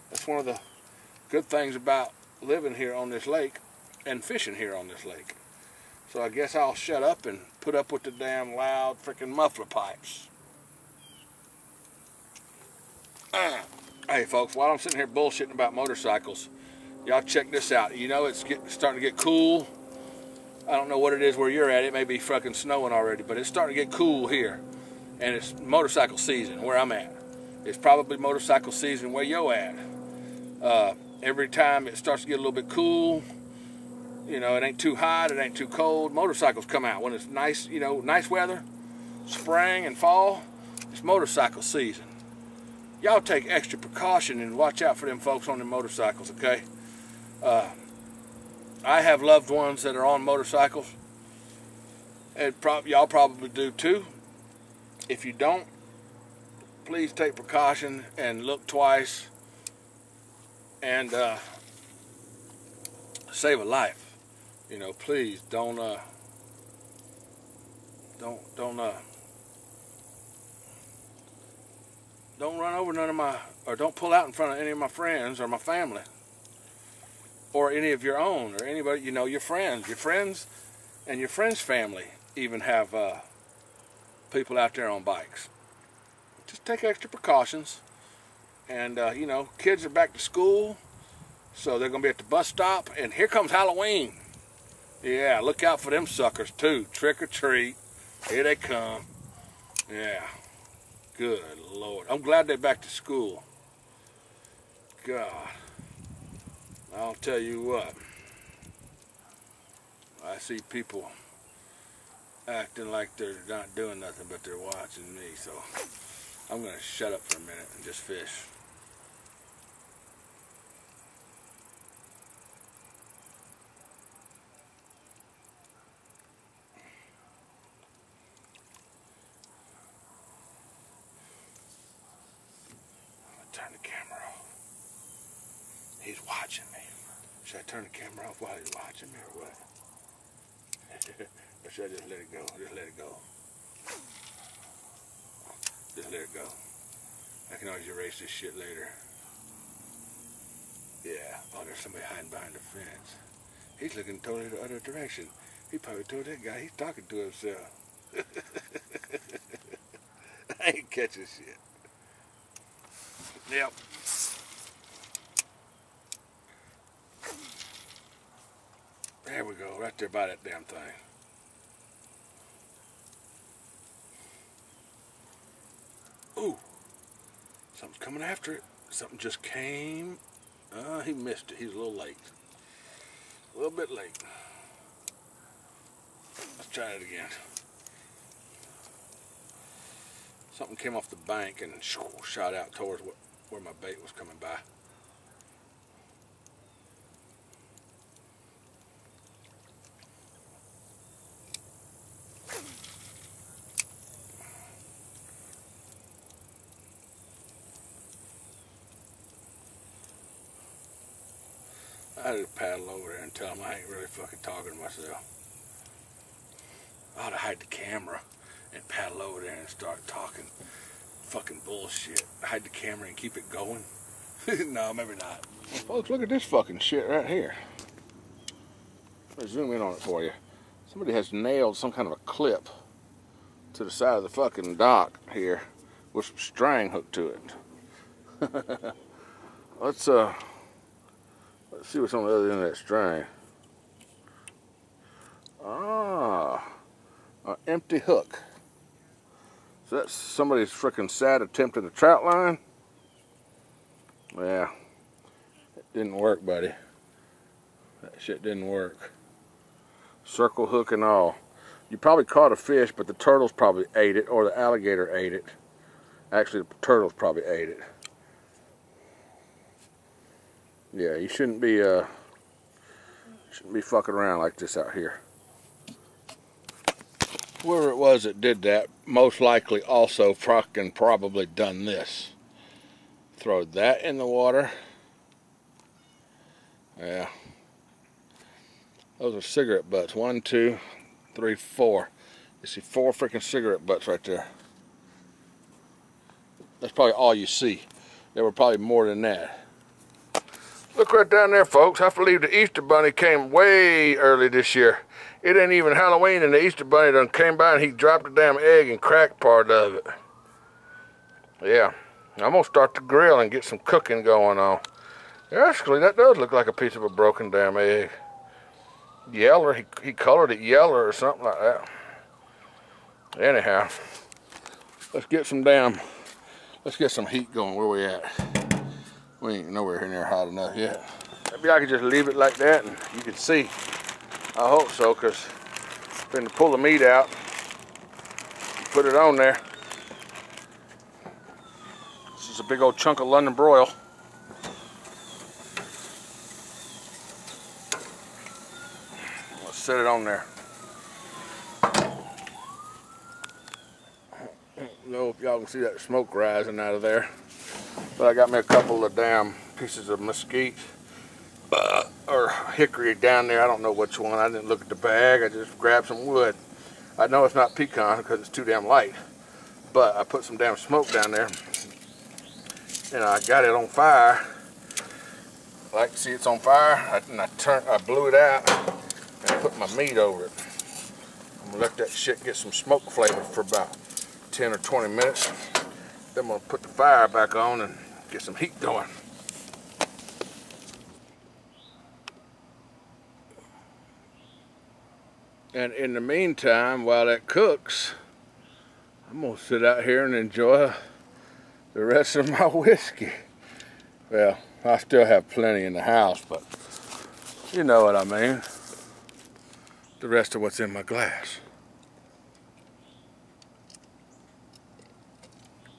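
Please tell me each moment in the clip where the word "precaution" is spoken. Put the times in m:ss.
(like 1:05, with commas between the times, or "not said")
0:43, 0:57, 1:27.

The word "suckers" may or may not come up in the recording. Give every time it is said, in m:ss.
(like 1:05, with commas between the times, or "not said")
1:36.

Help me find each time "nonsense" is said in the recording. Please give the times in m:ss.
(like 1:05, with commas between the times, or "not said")
not said.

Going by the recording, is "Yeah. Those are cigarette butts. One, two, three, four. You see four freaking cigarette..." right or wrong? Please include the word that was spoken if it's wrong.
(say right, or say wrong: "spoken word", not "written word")
right.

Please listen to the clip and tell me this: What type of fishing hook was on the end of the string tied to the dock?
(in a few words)
circle hook.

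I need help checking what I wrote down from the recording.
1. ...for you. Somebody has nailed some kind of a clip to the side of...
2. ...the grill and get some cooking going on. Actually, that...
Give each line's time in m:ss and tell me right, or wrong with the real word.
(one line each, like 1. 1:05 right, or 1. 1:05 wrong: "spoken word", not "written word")
1. 3:49 right
2. 5:12 right.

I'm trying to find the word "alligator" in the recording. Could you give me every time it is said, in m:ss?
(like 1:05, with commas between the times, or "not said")
4:24.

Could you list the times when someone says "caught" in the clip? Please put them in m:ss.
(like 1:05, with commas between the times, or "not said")
4:22.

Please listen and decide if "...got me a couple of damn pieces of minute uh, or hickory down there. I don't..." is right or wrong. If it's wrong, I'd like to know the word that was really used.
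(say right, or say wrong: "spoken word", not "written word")
wrong: "mesquite", not "minute".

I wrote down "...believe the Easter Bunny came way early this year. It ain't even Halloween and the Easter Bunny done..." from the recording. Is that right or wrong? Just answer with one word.
right.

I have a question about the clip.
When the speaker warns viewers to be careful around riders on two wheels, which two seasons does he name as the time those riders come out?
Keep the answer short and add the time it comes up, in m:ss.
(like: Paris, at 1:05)
spring and fall, at 0:39.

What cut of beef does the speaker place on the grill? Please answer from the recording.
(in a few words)
London broil.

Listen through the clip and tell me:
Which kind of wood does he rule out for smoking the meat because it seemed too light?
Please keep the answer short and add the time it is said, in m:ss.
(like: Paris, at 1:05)
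pecan, at 6:07.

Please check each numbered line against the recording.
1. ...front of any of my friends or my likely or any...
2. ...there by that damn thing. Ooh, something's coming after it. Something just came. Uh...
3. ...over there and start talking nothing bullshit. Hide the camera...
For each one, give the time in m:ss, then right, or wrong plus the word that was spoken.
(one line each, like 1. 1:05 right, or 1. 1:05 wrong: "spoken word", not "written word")
1. 1:14 wrong: "family", not "likely"
2. 2:49 right
3. 3:39 wrong: "fucking", not "nothing".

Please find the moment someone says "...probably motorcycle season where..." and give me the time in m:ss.
0:27.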